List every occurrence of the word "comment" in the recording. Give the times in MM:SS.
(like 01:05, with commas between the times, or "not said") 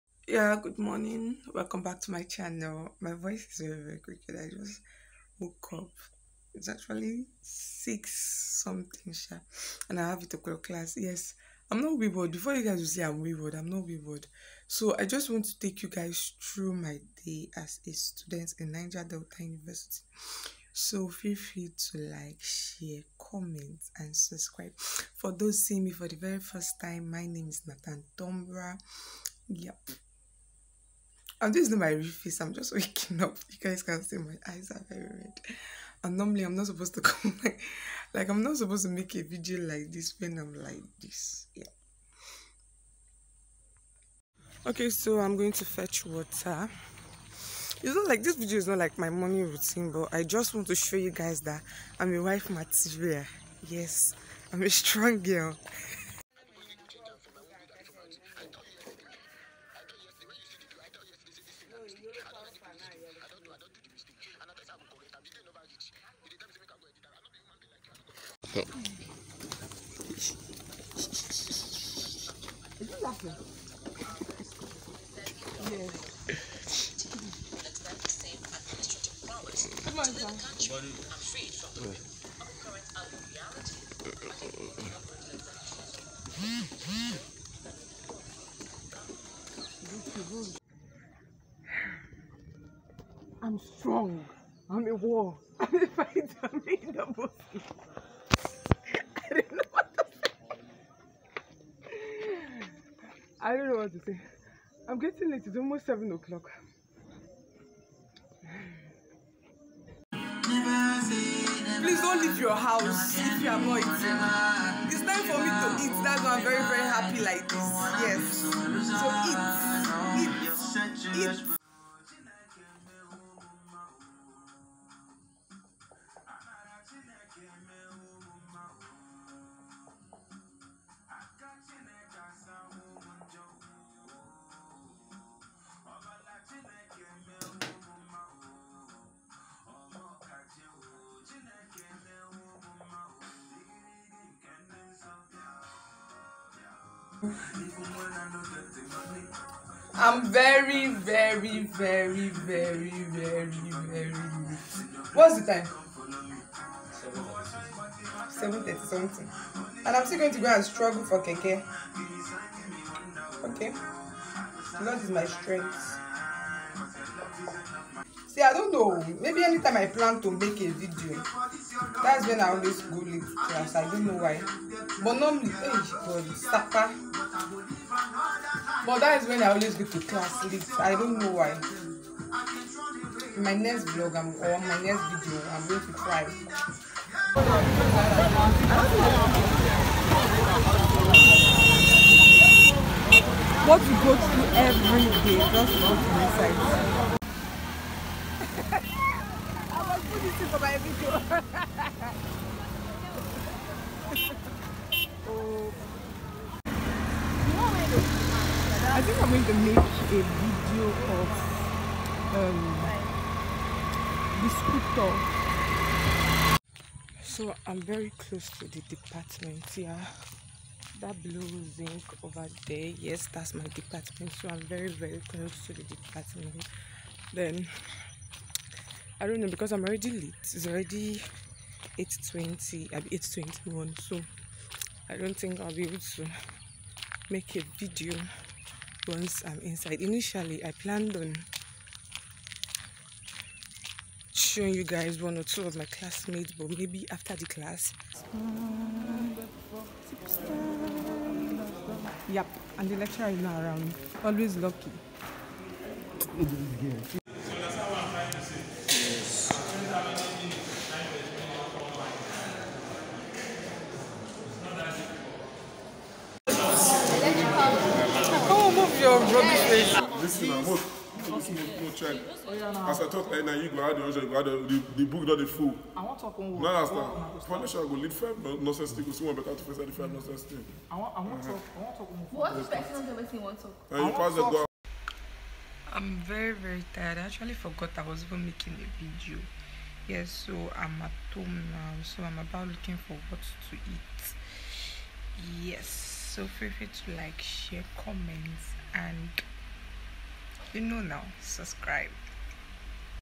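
00:23, 04:57.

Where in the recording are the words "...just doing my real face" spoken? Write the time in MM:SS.
00:31.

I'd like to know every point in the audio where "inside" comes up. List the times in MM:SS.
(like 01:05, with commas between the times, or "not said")
03:16, 03:59.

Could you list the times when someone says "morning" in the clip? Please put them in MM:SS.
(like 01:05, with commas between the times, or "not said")
00:00, 00:49.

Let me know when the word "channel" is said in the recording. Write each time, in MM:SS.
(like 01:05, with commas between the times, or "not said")
00:02.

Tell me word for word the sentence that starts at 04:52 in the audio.
So I'm about looking for what to eat.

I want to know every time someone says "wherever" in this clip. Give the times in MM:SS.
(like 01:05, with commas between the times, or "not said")
not said.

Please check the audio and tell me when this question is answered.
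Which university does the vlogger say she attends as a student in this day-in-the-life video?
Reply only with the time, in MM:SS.
00:18.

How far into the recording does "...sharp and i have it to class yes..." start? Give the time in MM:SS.
00:09.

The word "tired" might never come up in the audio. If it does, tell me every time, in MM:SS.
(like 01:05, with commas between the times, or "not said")
04:46.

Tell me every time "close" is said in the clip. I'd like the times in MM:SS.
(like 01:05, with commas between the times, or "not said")
03:38, 03:45.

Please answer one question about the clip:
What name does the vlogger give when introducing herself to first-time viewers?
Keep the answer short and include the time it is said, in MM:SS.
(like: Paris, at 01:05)
Nathan Tonbra, at 00:27.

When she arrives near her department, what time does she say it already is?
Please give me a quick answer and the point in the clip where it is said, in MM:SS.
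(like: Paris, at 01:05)
8:20, at 03:51.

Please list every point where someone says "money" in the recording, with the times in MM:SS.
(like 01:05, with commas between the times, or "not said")
not said.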